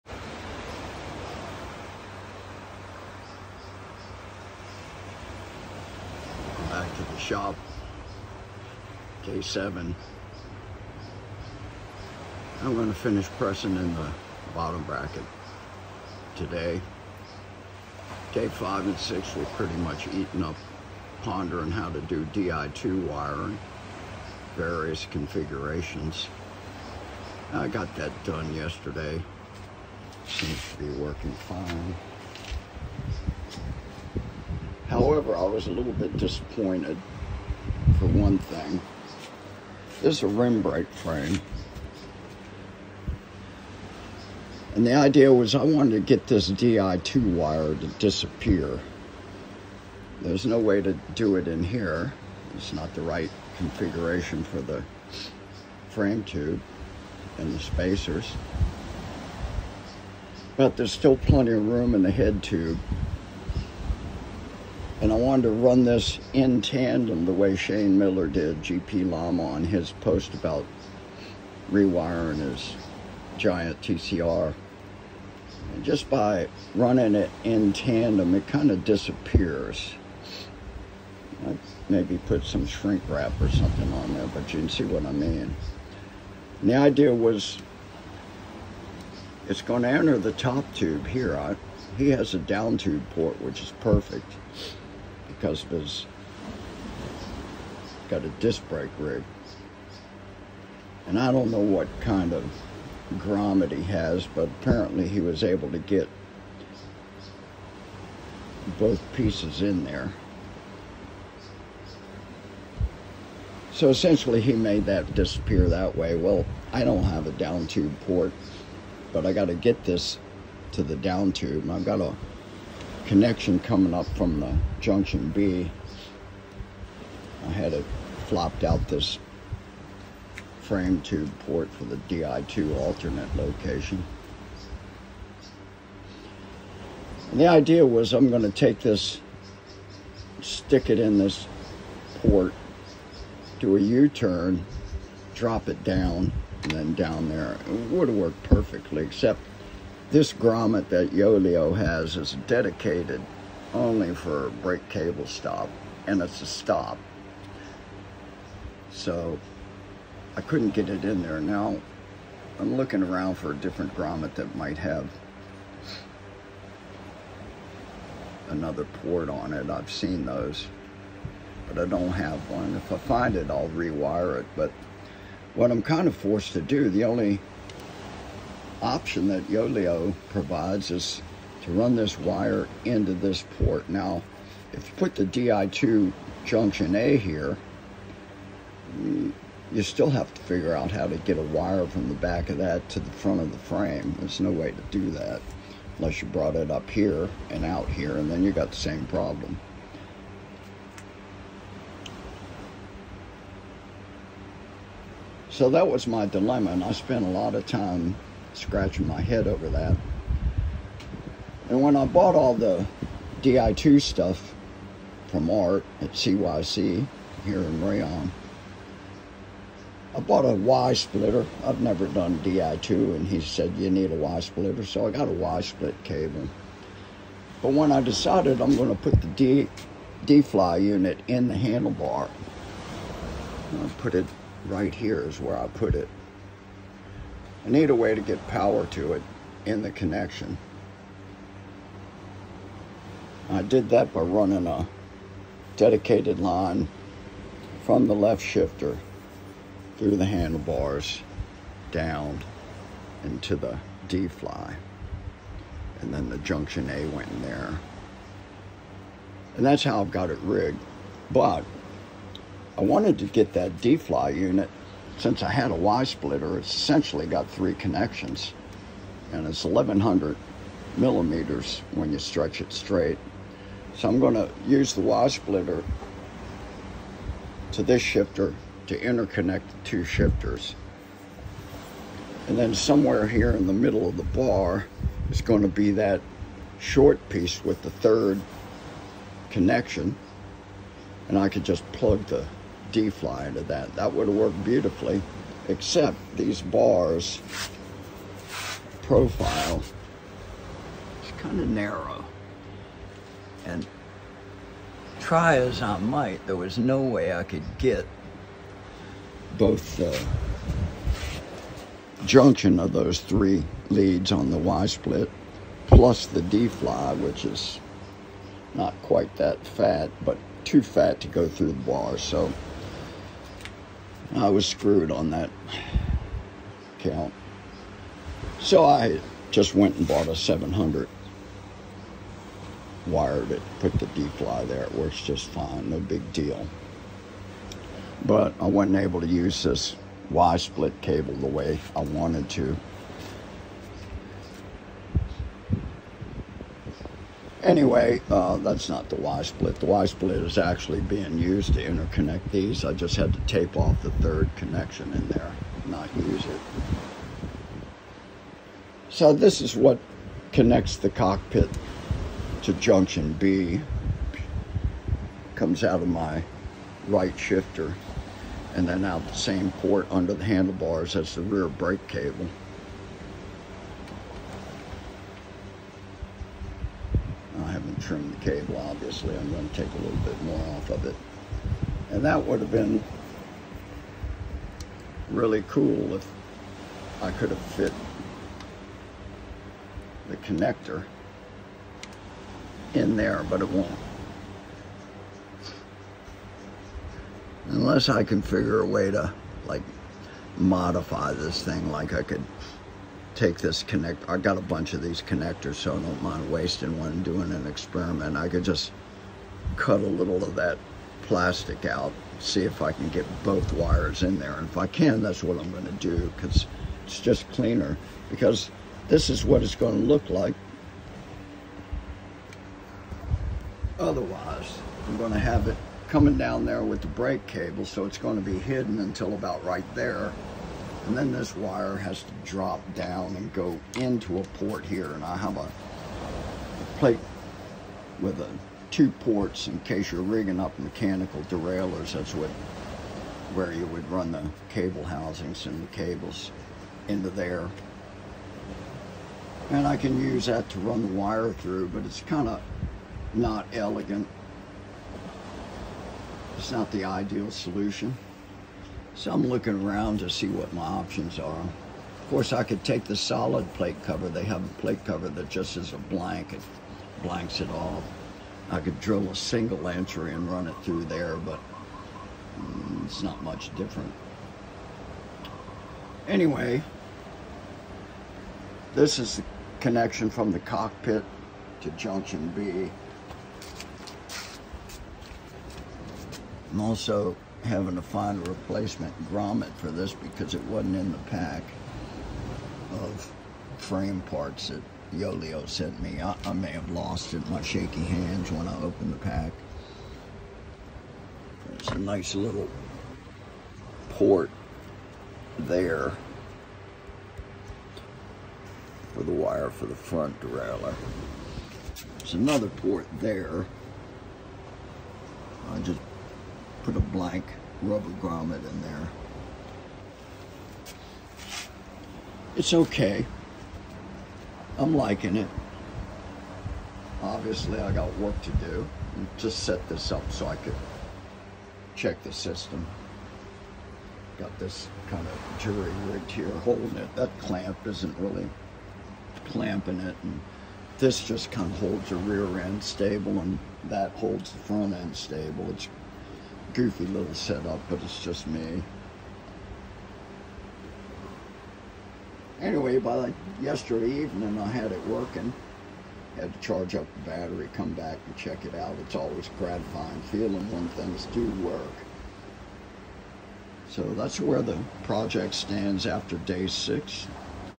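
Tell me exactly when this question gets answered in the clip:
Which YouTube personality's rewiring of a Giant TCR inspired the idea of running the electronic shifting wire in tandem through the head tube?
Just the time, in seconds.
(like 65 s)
67 s.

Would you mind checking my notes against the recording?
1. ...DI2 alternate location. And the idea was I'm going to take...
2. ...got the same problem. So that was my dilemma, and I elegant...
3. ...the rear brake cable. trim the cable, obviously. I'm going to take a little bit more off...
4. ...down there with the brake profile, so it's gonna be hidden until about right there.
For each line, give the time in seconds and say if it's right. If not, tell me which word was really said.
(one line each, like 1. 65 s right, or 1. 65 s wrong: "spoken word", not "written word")
1. 132 s right
2. 198 s wrong: "spent", not "elegant"
3. 371 s right
4. 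426 s wrong: "cable", not "profile".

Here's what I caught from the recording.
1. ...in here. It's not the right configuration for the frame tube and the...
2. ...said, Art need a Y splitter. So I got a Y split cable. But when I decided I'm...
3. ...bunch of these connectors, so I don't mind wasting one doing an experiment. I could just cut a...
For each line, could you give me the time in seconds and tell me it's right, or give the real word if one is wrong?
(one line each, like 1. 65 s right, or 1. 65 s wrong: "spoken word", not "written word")
1. 51 s right
2. 223 s wrong: "You", not "Art"
3. 404 s right.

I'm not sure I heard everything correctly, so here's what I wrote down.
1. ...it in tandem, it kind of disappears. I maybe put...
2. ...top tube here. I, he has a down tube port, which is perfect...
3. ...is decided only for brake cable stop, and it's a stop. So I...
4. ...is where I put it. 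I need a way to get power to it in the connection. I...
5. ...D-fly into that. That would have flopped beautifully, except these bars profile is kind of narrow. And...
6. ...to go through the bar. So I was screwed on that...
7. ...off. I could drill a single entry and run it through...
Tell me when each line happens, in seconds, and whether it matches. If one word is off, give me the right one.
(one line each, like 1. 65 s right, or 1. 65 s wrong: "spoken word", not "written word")
1. 77 s right
2. 90 s right
3. 152 s wrong: "dedicated", not "decided"
4. 235 s right
5. 292 s wrong: "worked", not "flopped"
6. 321 s right
7. 467 s right.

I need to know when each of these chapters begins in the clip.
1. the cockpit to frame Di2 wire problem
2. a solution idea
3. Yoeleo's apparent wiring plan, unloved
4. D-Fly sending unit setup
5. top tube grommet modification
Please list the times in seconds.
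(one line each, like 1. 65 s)
1. 32 s
2. 135 s
3. 184 s
4. 230 s
5. 400 s.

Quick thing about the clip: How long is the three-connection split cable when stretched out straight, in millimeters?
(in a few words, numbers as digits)
1100.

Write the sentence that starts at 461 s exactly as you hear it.
Of course, I could take the solid plate cover.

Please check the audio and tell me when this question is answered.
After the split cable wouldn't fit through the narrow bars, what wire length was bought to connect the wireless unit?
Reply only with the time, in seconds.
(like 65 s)
330 s.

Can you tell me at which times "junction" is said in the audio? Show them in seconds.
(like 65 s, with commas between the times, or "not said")
124 s, 186 s, 256 s, 312 s, 362 s, 481 s.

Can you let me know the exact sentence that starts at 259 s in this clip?
And that's how I've got it rigged.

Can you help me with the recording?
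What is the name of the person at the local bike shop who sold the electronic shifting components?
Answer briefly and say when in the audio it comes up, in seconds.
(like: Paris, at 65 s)
Art, at 215 s.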